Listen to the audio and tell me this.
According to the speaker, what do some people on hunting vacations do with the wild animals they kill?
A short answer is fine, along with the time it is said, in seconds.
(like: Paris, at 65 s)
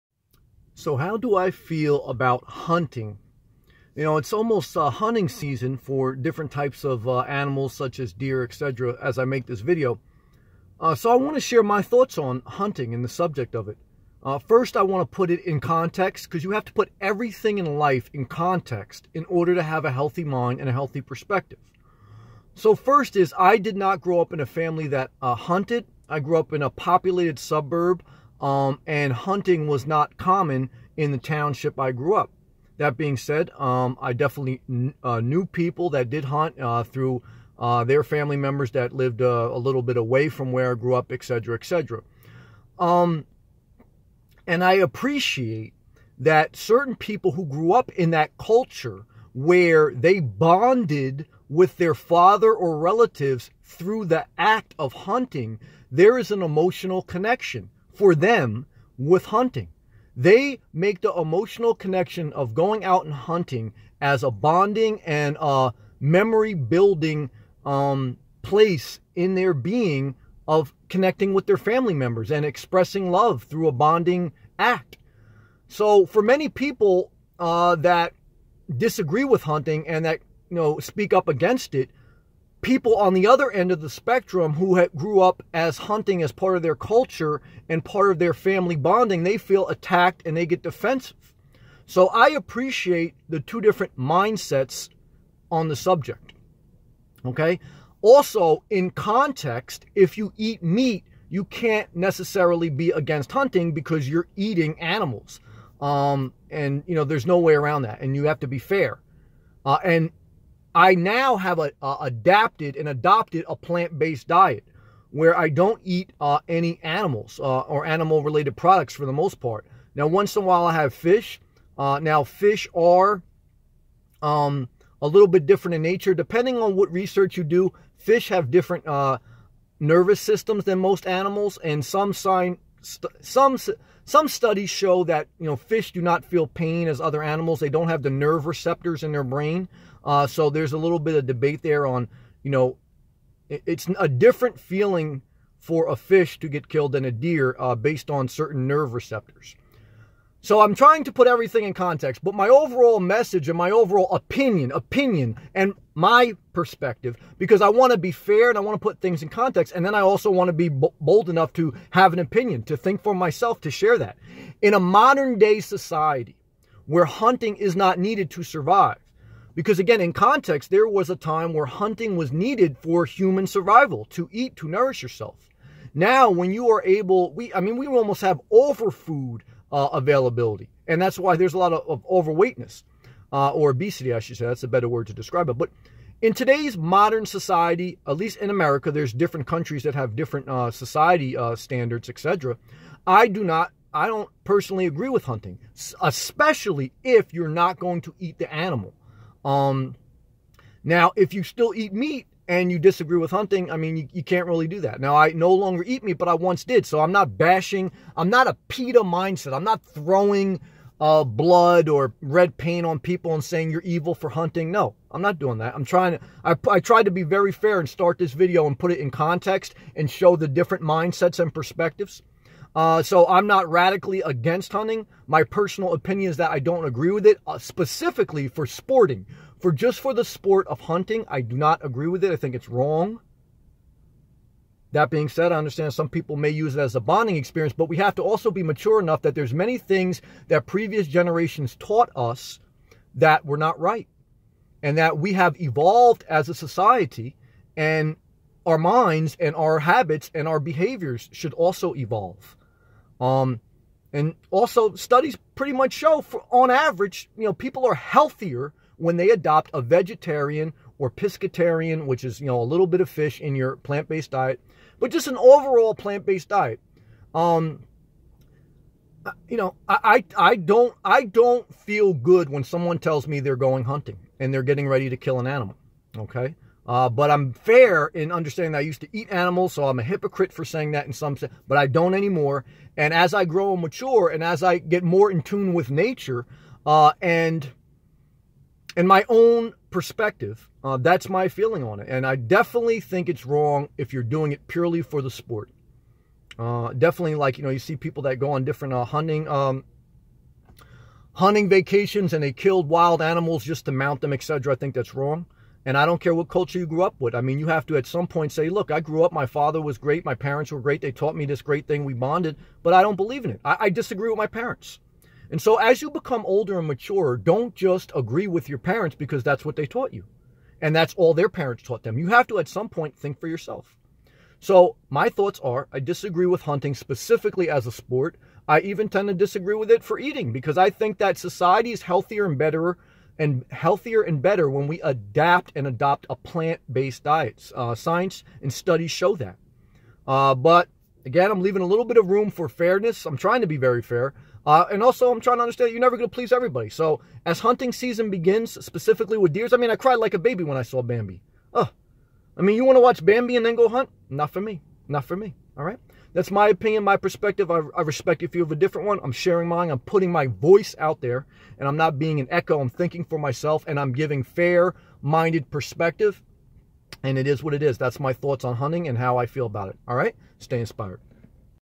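Mount them, at 303 s.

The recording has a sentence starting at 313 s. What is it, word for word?
I, I disagree with my parents.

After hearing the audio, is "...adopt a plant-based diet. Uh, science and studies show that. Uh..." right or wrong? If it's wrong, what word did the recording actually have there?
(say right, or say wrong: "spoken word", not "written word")
right.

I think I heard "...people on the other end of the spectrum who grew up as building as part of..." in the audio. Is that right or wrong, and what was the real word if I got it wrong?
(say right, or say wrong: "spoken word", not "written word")
wrong: "hunting", not "building".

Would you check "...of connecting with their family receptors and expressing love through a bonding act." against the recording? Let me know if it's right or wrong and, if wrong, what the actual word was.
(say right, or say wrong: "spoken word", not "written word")
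wrong: "members", not "receptors".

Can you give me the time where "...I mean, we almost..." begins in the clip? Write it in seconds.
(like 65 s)
177 s.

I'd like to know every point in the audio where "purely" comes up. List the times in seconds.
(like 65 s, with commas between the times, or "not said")
294 s.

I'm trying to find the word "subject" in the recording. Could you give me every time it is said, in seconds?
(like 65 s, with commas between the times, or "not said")
13 s, 95 s.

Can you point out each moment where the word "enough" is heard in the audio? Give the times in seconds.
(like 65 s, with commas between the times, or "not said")
161 s, 239 s.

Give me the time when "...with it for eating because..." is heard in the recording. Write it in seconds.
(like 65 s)
329 s.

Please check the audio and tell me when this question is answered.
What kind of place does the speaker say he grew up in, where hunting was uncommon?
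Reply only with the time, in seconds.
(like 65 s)
26 s.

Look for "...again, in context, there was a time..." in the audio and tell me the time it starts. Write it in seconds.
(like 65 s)
169 s.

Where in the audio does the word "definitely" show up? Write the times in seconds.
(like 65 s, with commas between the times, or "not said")
34 s, 292 s, 296 s.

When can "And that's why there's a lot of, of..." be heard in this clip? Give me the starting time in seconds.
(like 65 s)
180 s.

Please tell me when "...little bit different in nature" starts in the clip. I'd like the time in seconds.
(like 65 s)
125 s.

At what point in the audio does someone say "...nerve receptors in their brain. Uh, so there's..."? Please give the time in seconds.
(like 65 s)
138 s.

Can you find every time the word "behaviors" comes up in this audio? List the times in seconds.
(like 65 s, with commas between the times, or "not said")
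250 s.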